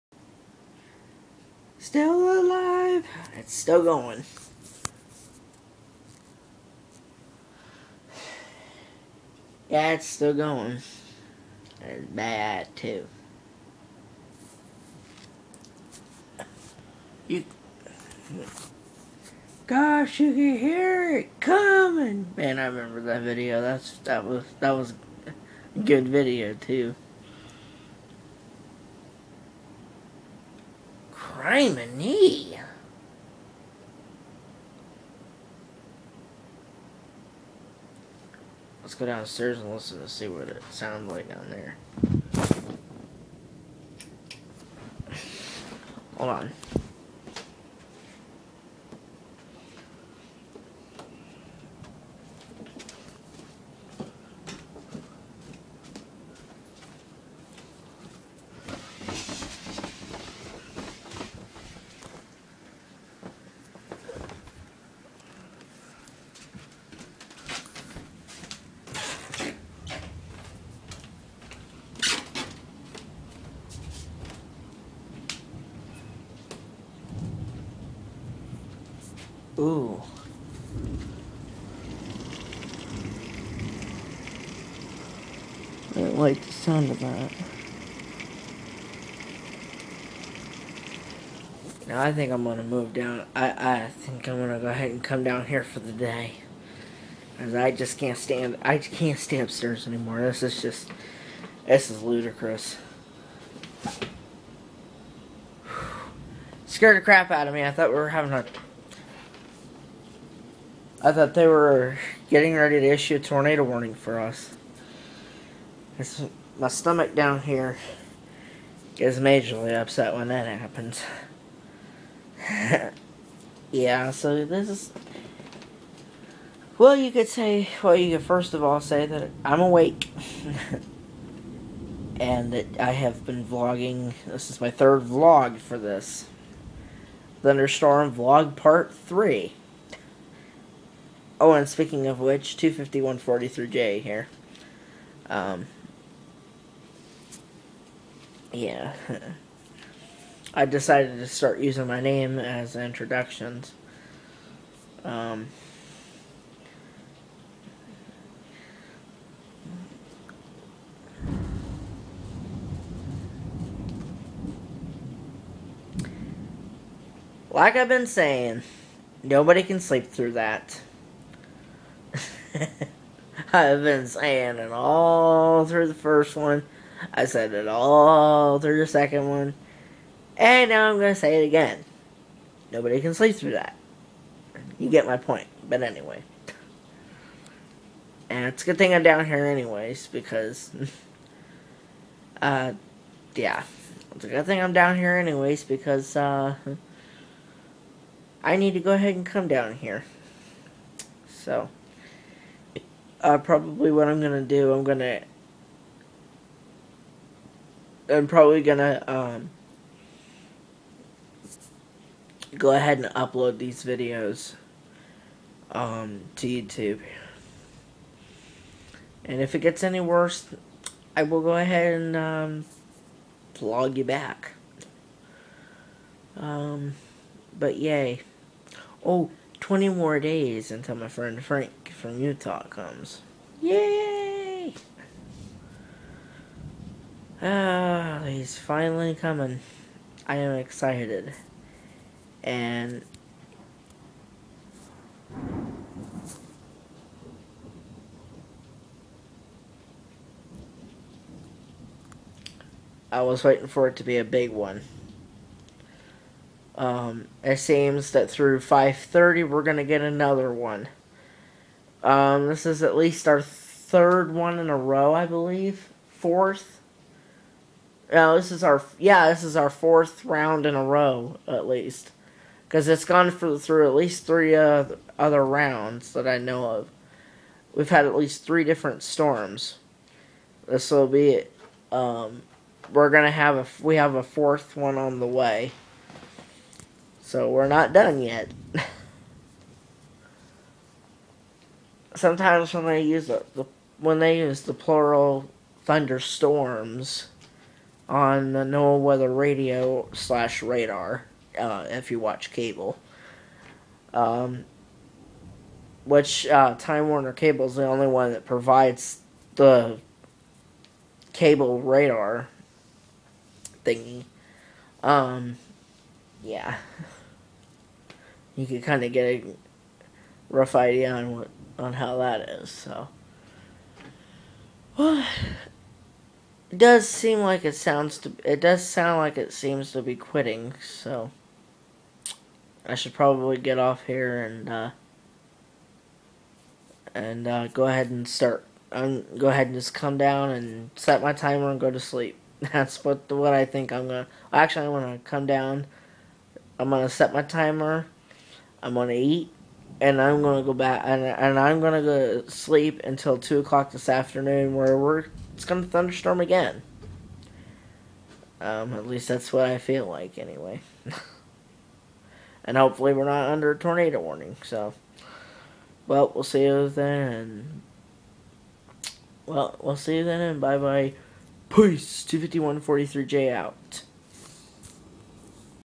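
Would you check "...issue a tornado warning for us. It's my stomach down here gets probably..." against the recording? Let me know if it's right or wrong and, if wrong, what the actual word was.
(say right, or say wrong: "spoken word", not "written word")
wrong: "majorly", not "probably".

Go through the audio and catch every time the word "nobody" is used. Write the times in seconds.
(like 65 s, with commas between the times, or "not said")
169 s, 182 s.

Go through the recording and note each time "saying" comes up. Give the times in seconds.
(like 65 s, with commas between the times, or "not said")
168 s, 174 s.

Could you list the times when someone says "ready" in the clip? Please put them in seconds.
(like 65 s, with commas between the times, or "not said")
112 s.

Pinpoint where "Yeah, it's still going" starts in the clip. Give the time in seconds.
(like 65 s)
9 s.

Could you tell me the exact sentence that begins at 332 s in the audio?
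I should probably get off here and, uh, and, uh, go ahead and start.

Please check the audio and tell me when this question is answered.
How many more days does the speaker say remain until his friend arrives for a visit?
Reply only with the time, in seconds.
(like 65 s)
229 s.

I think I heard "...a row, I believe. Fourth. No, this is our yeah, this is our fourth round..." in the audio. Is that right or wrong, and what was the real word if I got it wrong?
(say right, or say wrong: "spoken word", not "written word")
right.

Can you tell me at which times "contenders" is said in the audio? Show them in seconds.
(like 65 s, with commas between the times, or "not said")
not said.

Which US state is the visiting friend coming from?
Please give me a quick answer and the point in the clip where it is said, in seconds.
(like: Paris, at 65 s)
Utah, at 232 s.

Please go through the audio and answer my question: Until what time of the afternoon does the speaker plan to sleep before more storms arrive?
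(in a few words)
2 o'clock.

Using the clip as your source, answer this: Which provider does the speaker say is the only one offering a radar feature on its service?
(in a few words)
Time Warner Cable.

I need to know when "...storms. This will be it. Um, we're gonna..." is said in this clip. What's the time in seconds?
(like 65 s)
279 s.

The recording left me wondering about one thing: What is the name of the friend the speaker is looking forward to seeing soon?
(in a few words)
Frank.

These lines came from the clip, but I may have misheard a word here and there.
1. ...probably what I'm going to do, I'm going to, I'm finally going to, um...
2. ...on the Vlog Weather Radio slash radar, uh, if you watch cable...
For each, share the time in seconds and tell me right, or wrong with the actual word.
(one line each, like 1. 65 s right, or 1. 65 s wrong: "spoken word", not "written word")
1. 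203 s wrong: "probably", not "finally"
2. 298 s wrong: "NOAA", not "Vlog".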